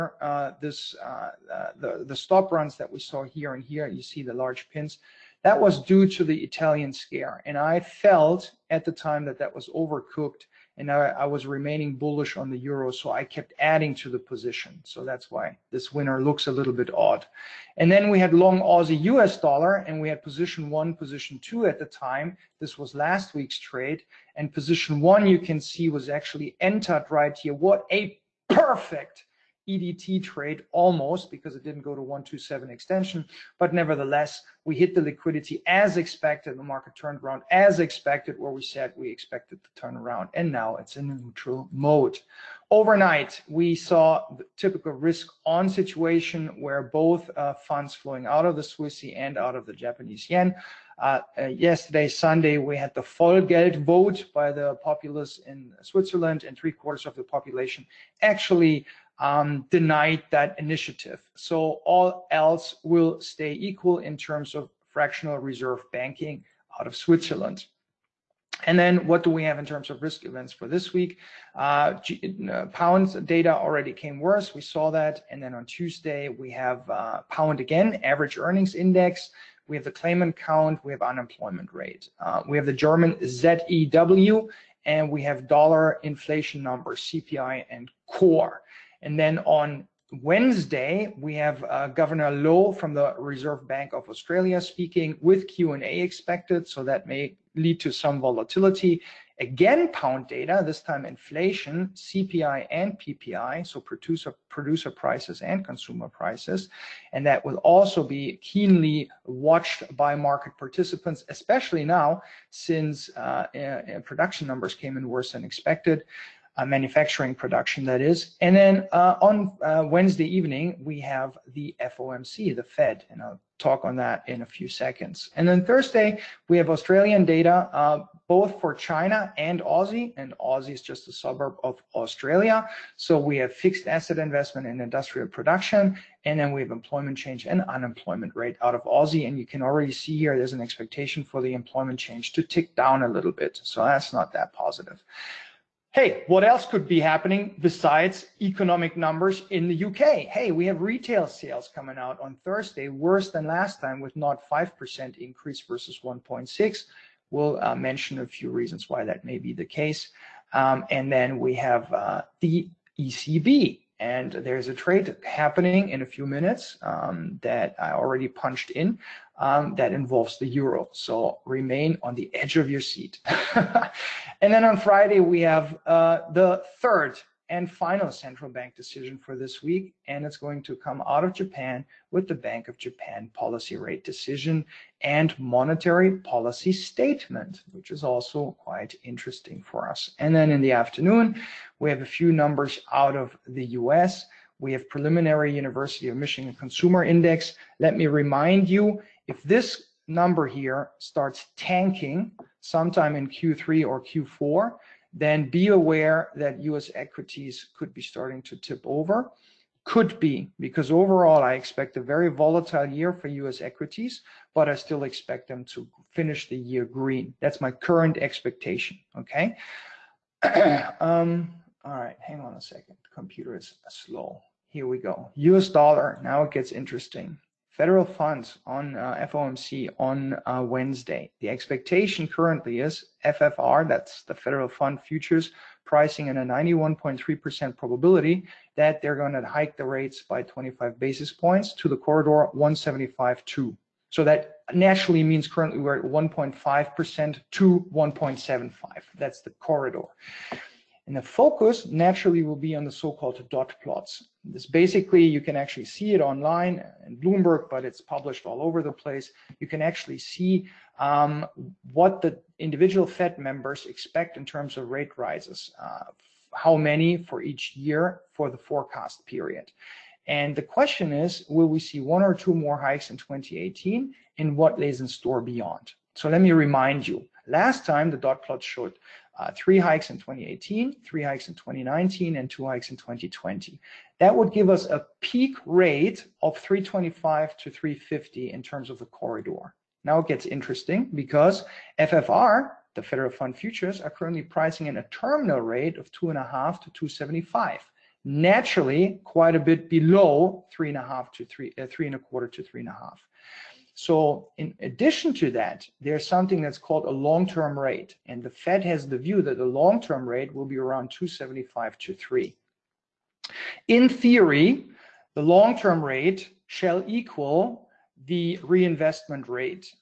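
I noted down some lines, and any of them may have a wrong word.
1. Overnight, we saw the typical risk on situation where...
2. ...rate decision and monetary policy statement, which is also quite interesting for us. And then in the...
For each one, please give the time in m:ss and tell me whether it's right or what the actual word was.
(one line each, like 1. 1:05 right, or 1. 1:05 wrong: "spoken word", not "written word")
1. 0:42 right
2. 3:03 right.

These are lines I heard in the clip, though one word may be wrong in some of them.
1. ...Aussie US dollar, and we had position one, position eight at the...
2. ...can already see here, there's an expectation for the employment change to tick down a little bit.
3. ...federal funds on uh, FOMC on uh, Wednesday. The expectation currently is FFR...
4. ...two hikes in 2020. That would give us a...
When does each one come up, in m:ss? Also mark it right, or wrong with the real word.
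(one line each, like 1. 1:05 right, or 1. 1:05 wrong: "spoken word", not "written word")
1. 0:18 wrong: "two", not "eight"
2. 2:19 right
3. 3:47 right
4. 4:42 right.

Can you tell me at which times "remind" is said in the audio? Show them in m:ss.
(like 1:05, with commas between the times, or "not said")
3:18, 4:36.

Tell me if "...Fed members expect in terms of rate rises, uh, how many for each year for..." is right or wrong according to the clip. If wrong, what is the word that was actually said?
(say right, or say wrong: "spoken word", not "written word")
right.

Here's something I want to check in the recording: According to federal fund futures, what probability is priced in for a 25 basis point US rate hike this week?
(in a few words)
91.3%.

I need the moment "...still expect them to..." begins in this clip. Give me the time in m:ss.
3:34.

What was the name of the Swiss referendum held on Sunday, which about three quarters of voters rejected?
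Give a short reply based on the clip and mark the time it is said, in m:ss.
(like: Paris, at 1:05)
Vollgeld, at 0:53.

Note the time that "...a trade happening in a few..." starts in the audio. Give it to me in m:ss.
2:44.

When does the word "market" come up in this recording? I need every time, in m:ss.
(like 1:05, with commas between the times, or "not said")
0:36, 1:50.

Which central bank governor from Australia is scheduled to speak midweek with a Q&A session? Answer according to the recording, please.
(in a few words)
Governor Lowe.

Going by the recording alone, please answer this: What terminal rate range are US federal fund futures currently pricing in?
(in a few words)
2.5% to 2.75%.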